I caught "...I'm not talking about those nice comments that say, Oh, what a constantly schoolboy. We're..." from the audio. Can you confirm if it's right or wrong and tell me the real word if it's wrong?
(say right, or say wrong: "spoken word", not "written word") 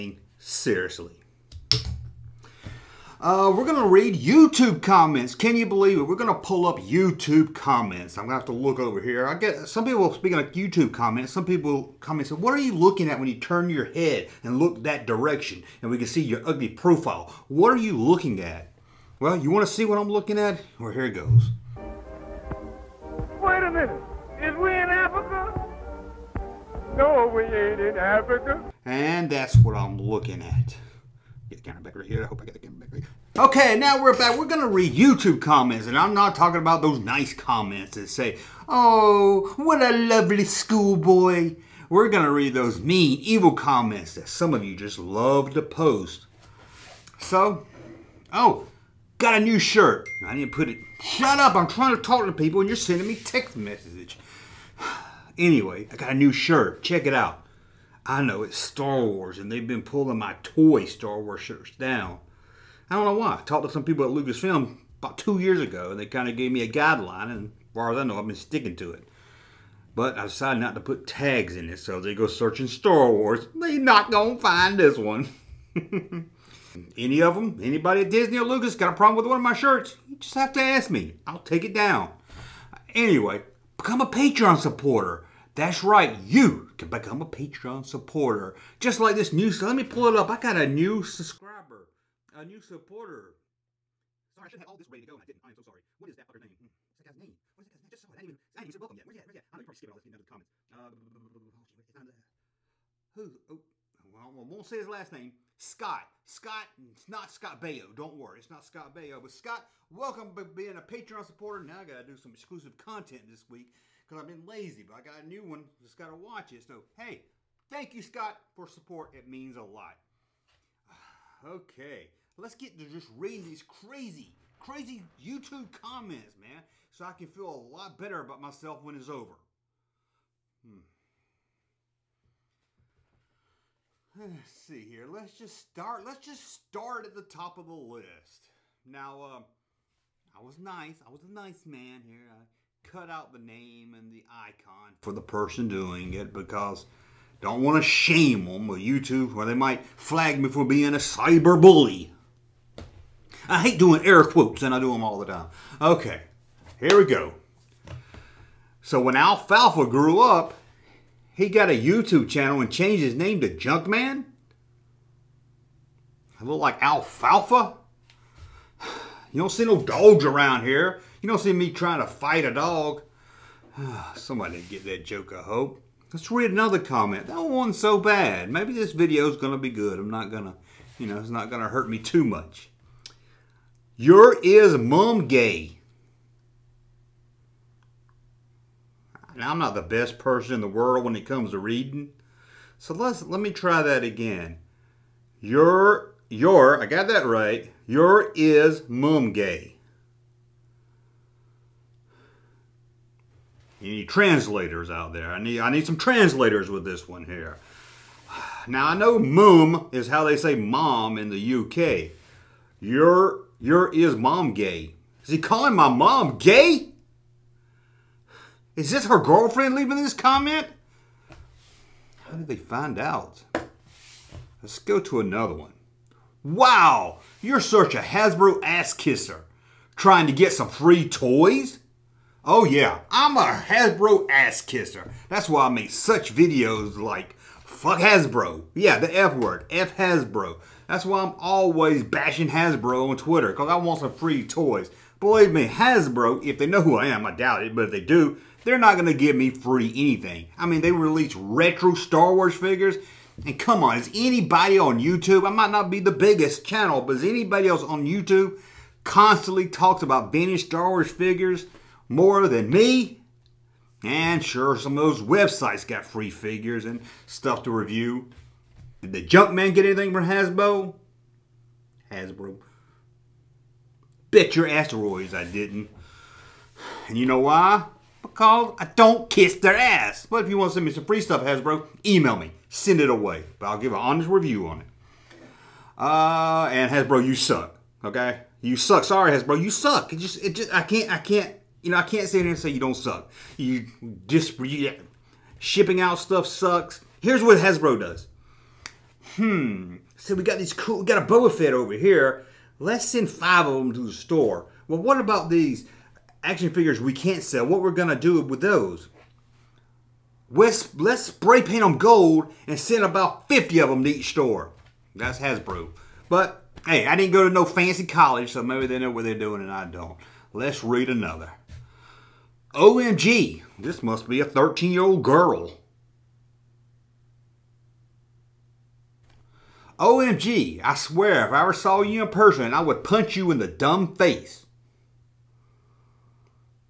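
wrong: "lovely", not "constantly".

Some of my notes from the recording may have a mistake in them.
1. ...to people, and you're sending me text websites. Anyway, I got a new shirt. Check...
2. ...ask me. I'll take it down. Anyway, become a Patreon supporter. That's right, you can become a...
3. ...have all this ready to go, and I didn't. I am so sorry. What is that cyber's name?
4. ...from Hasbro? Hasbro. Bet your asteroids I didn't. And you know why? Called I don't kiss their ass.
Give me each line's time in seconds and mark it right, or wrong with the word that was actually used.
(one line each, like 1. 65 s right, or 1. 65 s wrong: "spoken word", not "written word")
1. 52 s wrong: "messages", not "websites"
2. 80 s right
3. 94 s wrong: "fucker", not "cyber"
4. 270 s right.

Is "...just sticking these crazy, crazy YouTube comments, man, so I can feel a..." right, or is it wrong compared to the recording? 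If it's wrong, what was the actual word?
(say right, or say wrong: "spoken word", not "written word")
wrong: "reading", not "sticking".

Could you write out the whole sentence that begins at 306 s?
action figures we can't sell, what we're going to do with those.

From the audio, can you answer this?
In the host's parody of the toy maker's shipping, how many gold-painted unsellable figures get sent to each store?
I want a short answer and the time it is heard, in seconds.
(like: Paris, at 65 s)
50, at 313 s.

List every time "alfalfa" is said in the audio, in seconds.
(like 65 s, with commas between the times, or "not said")
159 s, 166 s.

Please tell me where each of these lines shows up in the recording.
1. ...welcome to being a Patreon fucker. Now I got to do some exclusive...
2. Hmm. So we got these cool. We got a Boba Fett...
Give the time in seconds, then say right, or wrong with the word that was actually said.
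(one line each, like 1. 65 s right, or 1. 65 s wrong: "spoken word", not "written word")
1. 109 s wrong: "supporter", not "fucker"
2. 299 s right.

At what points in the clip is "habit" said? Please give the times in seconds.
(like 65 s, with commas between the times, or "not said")
not said.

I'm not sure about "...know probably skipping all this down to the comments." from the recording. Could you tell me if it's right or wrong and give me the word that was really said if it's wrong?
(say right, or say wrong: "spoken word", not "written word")
right.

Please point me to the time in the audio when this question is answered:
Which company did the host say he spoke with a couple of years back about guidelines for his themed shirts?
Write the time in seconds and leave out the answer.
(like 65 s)
64 s.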